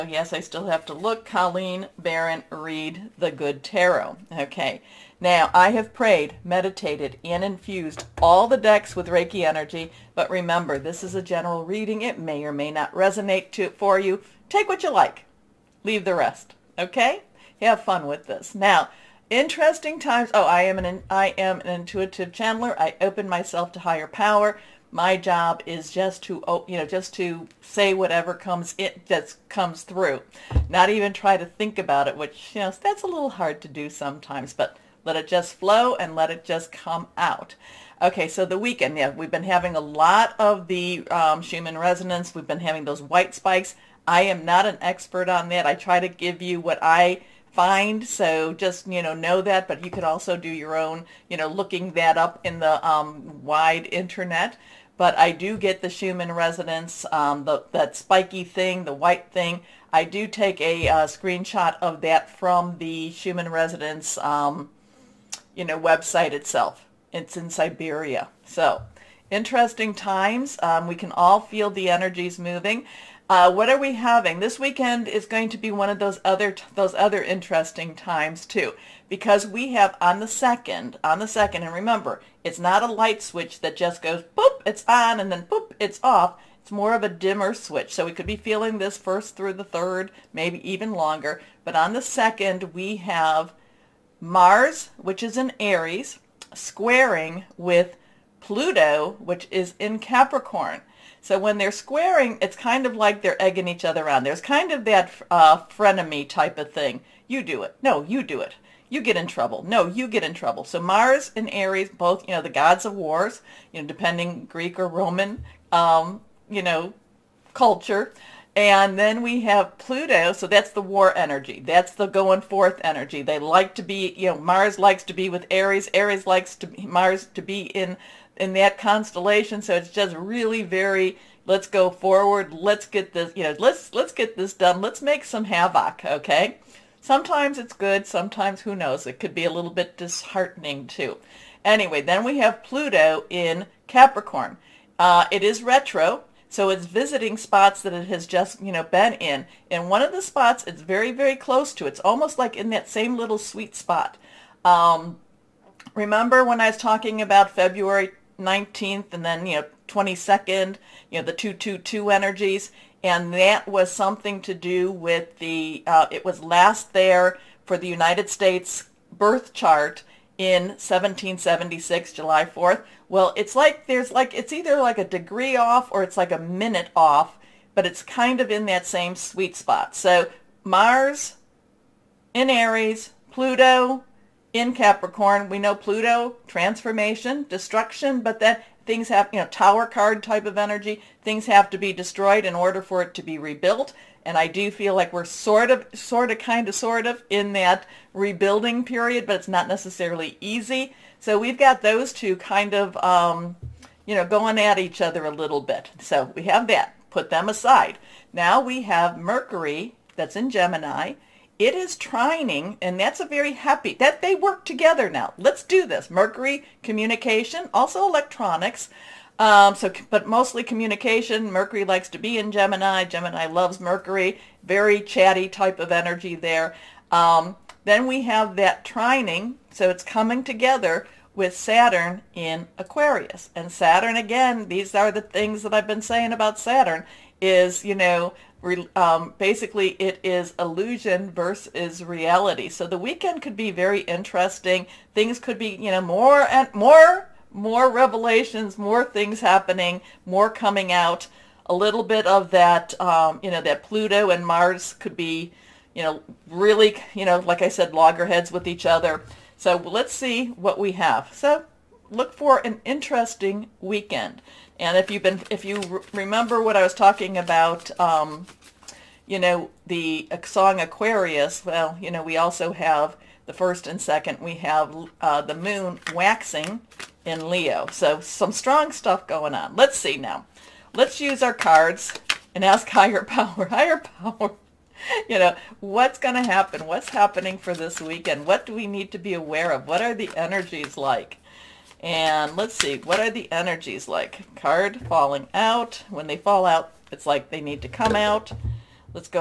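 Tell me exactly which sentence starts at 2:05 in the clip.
Aries likes to Mars to be in in that constellation.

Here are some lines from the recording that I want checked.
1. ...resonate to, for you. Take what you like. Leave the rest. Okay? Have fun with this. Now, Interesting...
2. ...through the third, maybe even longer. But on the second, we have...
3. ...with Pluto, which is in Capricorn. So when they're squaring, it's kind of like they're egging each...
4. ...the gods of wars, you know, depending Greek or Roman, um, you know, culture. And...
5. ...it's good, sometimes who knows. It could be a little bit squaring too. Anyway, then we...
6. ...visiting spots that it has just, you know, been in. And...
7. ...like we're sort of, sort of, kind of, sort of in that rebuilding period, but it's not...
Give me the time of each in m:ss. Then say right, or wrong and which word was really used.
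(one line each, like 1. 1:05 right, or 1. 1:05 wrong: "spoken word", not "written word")
1. 0:12 right
2. 1:29 right
3. 1:37 right
4. 1:52 right
5. 2:17 wrong: "disheartening", not "squaring"
6. 2:26 right
7. 3:14 right.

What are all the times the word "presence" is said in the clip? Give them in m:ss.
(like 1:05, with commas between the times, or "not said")
not said.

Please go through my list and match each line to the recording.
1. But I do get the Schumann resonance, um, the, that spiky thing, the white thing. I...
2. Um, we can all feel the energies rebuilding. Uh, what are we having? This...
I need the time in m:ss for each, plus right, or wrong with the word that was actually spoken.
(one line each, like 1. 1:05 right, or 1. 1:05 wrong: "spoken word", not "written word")
1. 0:54 right
2. 1:10 wrong: "moving", not "rebuilding".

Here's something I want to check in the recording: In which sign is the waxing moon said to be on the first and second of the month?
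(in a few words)
Leo.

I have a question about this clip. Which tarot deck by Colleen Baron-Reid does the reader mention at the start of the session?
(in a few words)
The Good Tarot.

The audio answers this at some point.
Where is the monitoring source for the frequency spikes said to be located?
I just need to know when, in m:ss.
1:07.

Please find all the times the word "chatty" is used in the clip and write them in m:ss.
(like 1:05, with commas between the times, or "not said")
3:45.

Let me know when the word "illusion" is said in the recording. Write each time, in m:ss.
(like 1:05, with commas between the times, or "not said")
4:00.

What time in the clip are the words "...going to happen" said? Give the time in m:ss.
4:46.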